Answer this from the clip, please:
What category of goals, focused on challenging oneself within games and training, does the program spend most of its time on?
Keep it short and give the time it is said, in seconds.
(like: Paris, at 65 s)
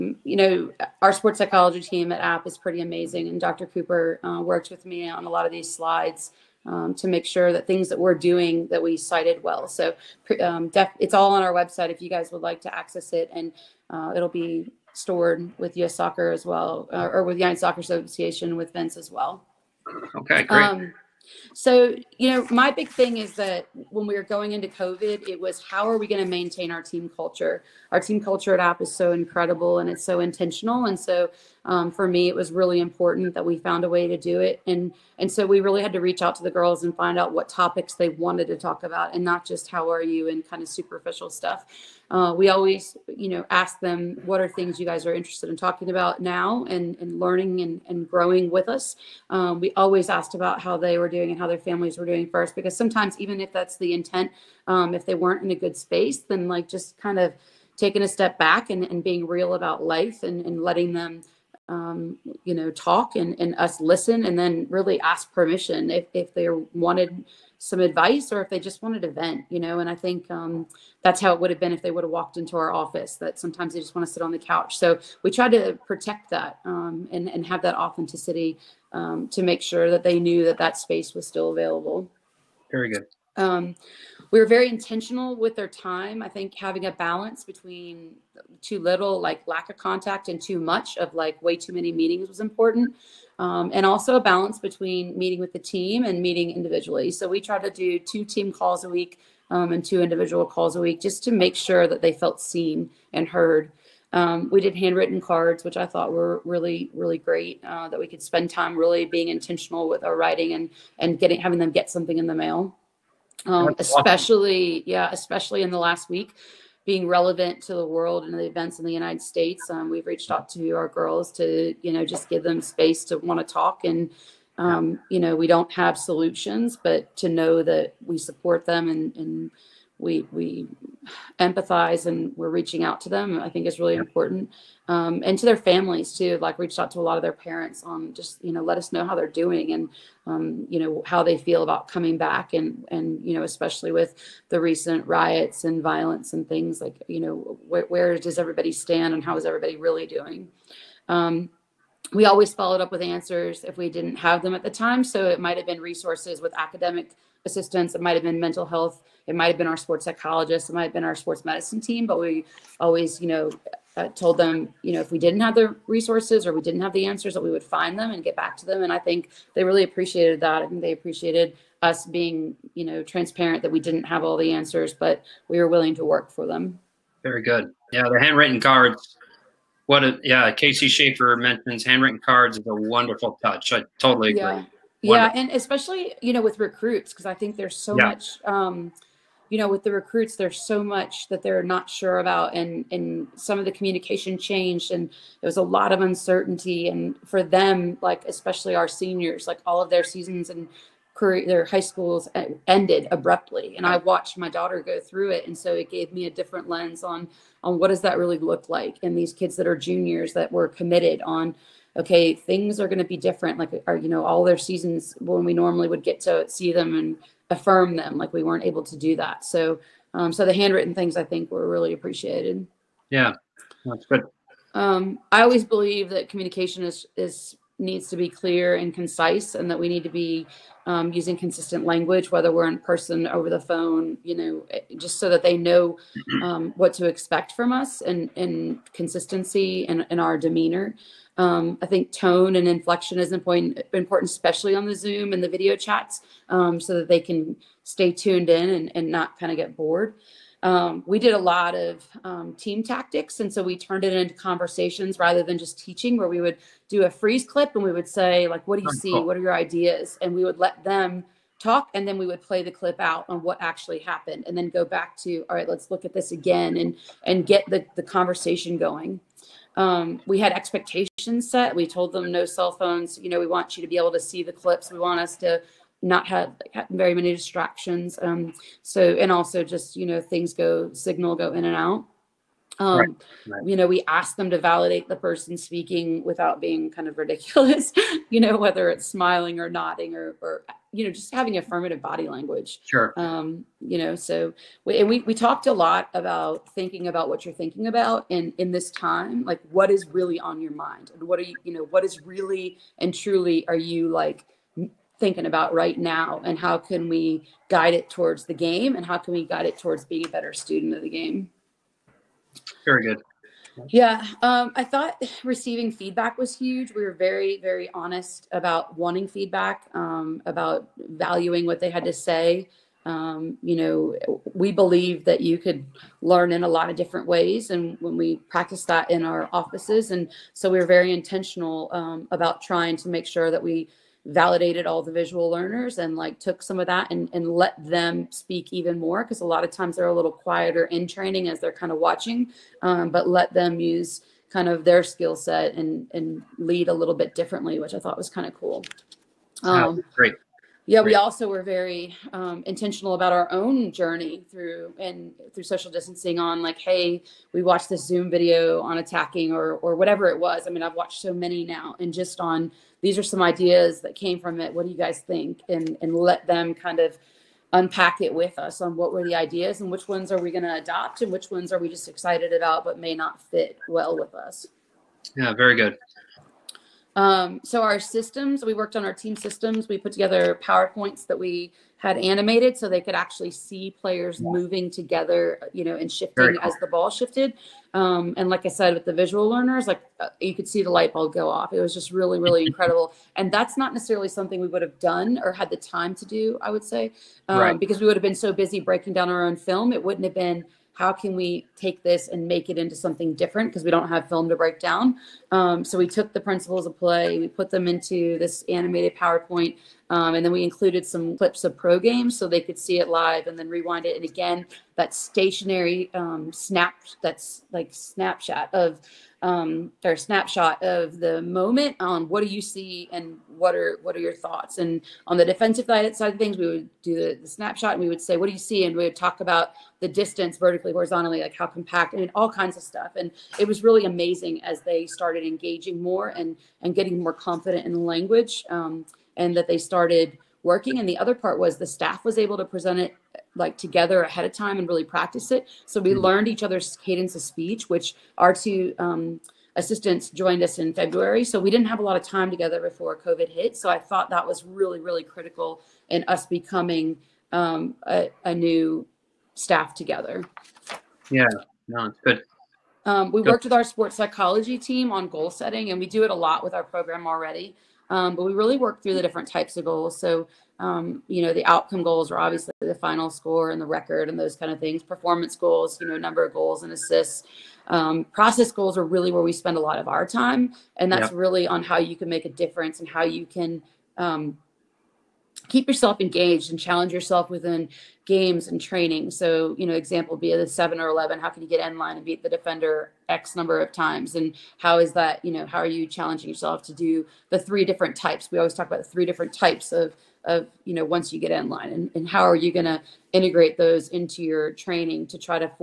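process goals, at 478 s.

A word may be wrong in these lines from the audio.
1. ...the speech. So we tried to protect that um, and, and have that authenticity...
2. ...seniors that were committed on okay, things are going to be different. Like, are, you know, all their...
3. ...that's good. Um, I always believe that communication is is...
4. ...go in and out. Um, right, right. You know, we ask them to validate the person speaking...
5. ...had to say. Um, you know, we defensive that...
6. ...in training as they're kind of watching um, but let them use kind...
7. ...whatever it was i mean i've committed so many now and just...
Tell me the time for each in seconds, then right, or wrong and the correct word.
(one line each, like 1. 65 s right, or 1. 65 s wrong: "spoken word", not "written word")
1. 74 s wrong: "couch", not "speech"
2. 209 s wrong: "juniors", not "seniors"
3. 223 s right
4. 281 s right
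5. 321 s wrong: "believe", not "defensive"
6. 340 s right
7. 359 s wrong: "watched", not "committed".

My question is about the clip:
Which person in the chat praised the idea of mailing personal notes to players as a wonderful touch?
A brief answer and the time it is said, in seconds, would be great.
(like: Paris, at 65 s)
Casey Schaefer, at 180 s.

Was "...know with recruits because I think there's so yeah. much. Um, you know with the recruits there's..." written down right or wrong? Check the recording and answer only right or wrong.
right.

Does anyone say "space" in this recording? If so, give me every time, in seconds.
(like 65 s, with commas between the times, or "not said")
55 s, 80 s, 122 s.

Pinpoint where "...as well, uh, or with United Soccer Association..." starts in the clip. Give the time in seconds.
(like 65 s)
16 s.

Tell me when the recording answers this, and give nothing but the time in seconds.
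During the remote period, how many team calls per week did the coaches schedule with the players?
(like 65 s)
97 s.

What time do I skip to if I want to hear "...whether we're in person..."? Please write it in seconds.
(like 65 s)
232 s.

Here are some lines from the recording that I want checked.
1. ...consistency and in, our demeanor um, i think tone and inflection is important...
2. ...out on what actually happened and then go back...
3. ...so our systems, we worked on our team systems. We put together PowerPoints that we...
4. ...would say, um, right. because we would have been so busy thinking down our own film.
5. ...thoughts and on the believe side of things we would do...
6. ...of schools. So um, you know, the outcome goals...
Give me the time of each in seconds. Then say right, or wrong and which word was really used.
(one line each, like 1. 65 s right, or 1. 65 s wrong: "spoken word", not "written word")
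1. 238 s right
2. 262 s right
3. 377 s right
4. 396 s wrong: "breaking", not "thinking"
5. 424 s wrong: "defensive", not "believe"
6. 469 s wrong: "goals", not "schools".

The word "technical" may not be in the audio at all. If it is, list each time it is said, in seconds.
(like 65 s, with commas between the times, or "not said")
not said.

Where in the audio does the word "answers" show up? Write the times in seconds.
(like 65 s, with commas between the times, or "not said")
153 s, 167 s, 174 s.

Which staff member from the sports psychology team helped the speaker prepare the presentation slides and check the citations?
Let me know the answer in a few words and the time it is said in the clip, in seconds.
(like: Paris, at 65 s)
Dr. Cooper, at 3 s.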